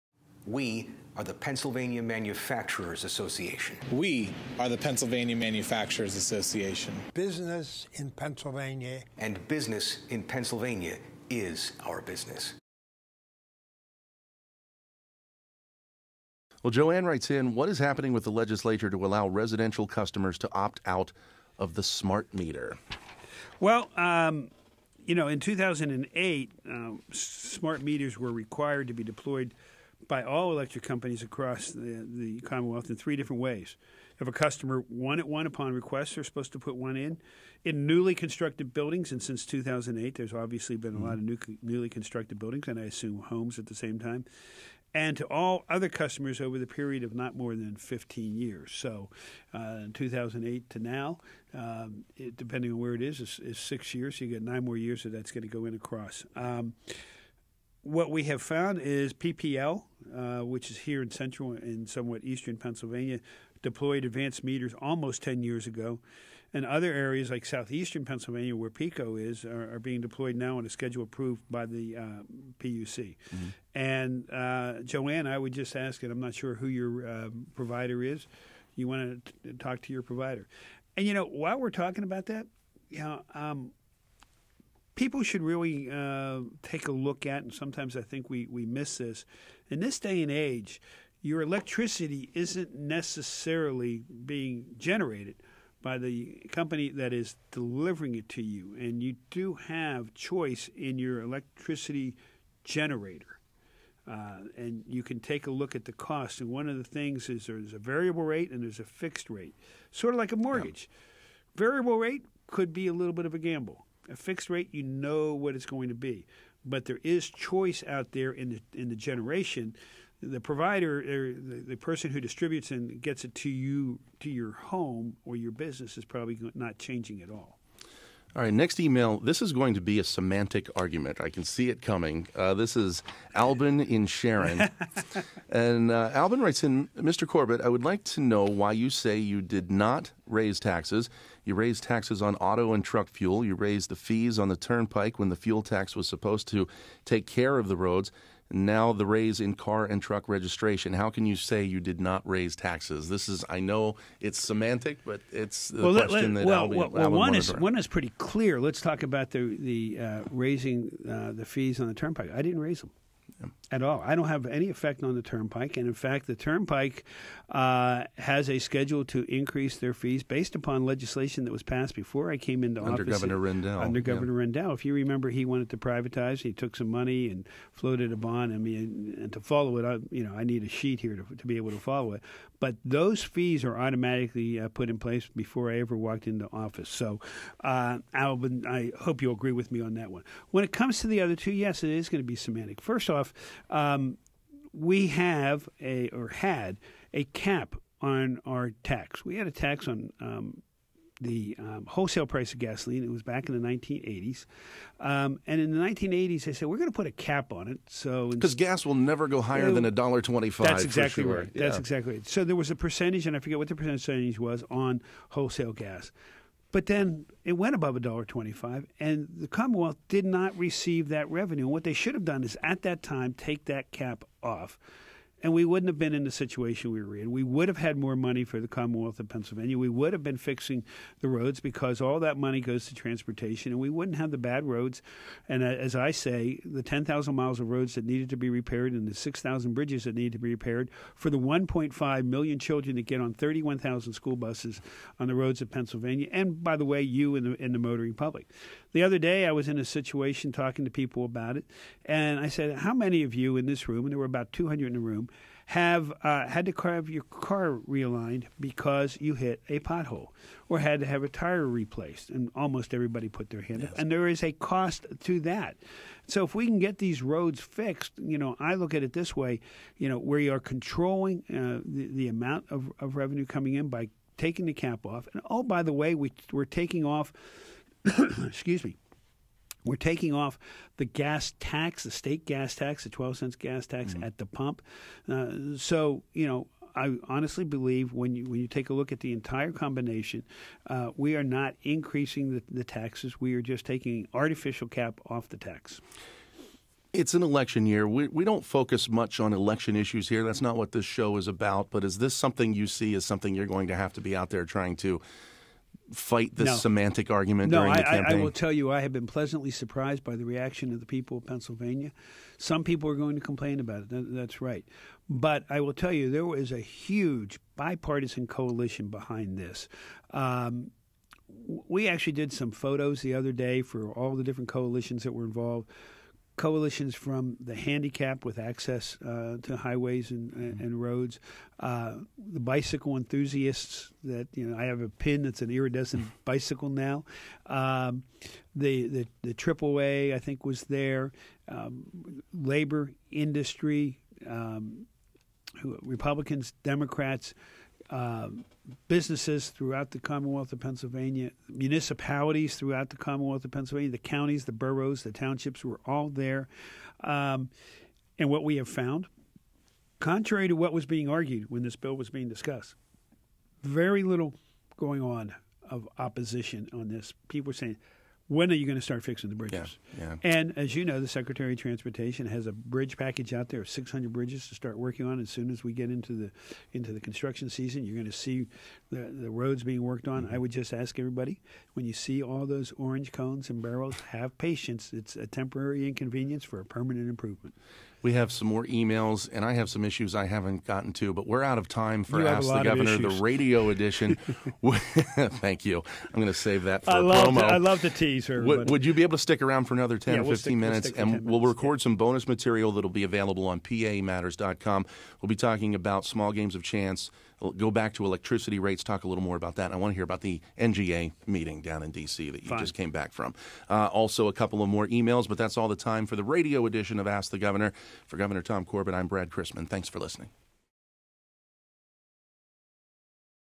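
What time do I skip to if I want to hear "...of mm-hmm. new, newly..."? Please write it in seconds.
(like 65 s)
41 s.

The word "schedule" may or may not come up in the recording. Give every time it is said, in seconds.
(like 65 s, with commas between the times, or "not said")
70 s, 168 s.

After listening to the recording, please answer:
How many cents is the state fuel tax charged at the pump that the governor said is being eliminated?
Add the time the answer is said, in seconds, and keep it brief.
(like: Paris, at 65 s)
12 cents, at 283 s.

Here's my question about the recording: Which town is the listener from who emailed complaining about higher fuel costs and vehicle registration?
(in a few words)
Sharon.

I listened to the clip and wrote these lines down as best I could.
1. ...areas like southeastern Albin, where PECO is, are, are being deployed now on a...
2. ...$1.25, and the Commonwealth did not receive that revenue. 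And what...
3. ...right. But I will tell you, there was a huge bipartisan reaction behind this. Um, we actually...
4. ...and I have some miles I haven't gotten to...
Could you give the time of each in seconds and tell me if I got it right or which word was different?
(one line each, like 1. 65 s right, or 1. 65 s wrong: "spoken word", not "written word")
1. 66 s wrong: "Pennsylvania", not "Albin"
2. 217 s right
3. 314 s wrong: "coalition", not "reaction"
4. 389 s wrong: "issues", not "miles".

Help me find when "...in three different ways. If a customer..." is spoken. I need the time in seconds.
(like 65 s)
32 s.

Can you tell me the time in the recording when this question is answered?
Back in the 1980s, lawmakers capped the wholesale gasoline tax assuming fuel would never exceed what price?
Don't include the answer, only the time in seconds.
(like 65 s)
209 s.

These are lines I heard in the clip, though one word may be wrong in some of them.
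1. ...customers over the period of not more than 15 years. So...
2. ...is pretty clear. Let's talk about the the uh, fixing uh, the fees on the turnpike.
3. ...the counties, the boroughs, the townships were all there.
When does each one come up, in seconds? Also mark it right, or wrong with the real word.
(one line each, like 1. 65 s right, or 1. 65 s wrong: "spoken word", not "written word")
1. 45 s right
2. 157 s wrong: "raising", not "fixing"
3. 354 s right.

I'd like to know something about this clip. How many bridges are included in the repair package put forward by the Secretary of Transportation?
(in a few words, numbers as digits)
600.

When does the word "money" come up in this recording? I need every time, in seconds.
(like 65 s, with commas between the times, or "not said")
176 s, 228 s, 232 s.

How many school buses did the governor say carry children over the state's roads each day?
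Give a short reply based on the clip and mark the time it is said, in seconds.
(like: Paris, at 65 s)
31,000, at 243 s.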